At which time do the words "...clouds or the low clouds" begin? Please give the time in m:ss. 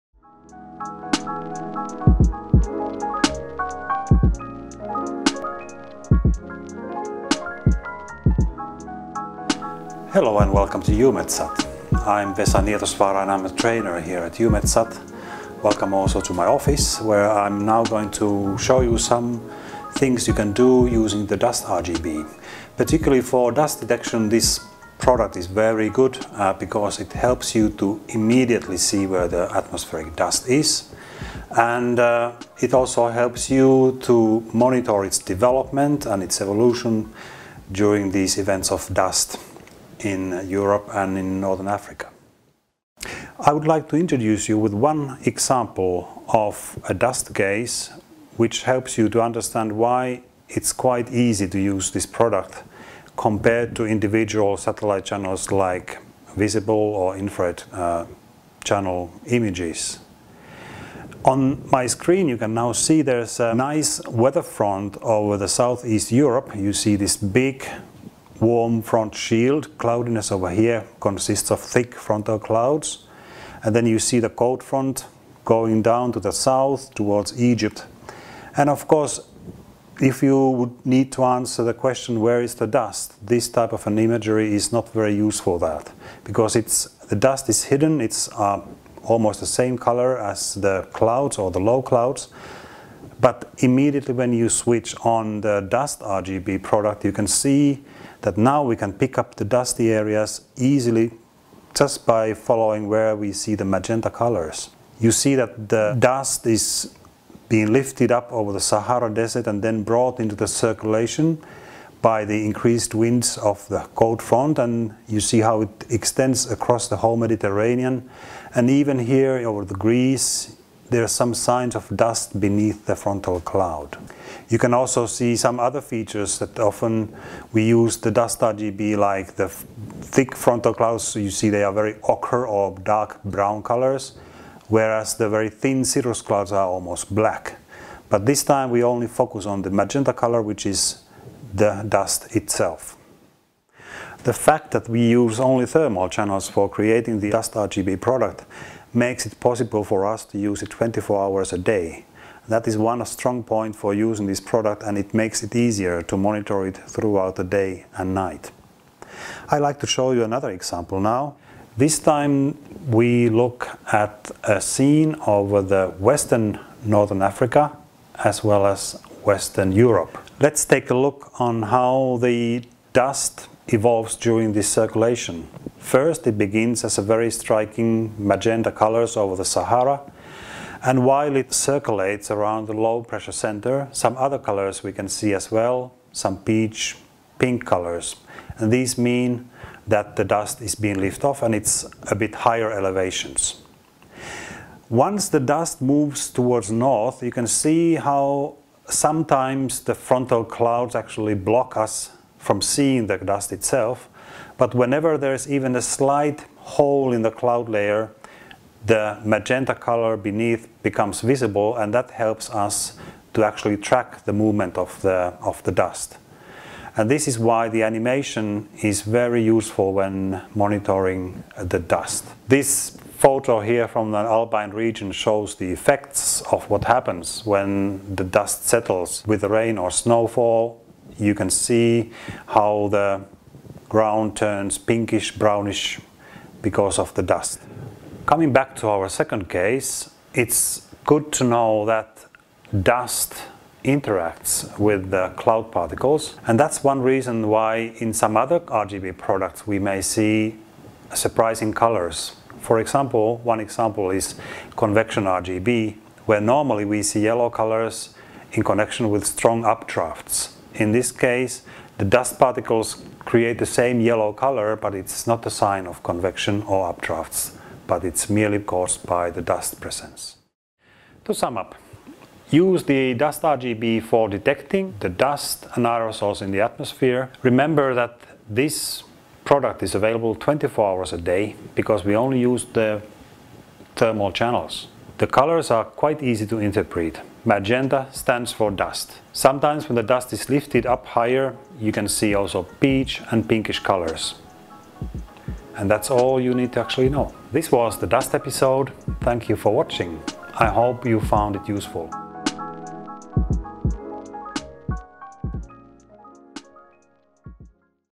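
1:30.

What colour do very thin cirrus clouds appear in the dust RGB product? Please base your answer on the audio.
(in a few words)
Almost black.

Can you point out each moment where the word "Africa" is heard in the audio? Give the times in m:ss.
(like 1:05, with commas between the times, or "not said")
0:41, 2:47.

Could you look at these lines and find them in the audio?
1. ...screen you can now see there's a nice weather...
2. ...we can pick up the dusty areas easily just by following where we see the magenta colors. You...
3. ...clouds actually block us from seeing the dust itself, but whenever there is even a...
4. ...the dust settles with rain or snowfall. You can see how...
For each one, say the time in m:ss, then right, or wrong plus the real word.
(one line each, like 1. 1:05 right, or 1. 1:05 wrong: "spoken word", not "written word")
1. 1:01 right
2. 1:38 right
3. 3:20 right
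4. 3:48 right.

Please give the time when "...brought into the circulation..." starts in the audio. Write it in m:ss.
1:49.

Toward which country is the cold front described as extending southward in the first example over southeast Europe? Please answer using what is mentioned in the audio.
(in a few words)
Egypt.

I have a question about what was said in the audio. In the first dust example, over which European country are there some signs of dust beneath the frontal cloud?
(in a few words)
Greece.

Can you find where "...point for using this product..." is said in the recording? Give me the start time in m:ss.
2:33.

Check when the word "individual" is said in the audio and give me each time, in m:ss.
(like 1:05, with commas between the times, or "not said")
0:53.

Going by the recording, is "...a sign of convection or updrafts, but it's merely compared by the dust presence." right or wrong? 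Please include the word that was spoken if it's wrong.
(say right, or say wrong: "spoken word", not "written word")
wrong: "caused", not "compared".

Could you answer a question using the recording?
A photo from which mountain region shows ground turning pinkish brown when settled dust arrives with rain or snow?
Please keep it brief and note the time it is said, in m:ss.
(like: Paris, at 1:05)
Alpine region, at 3:44.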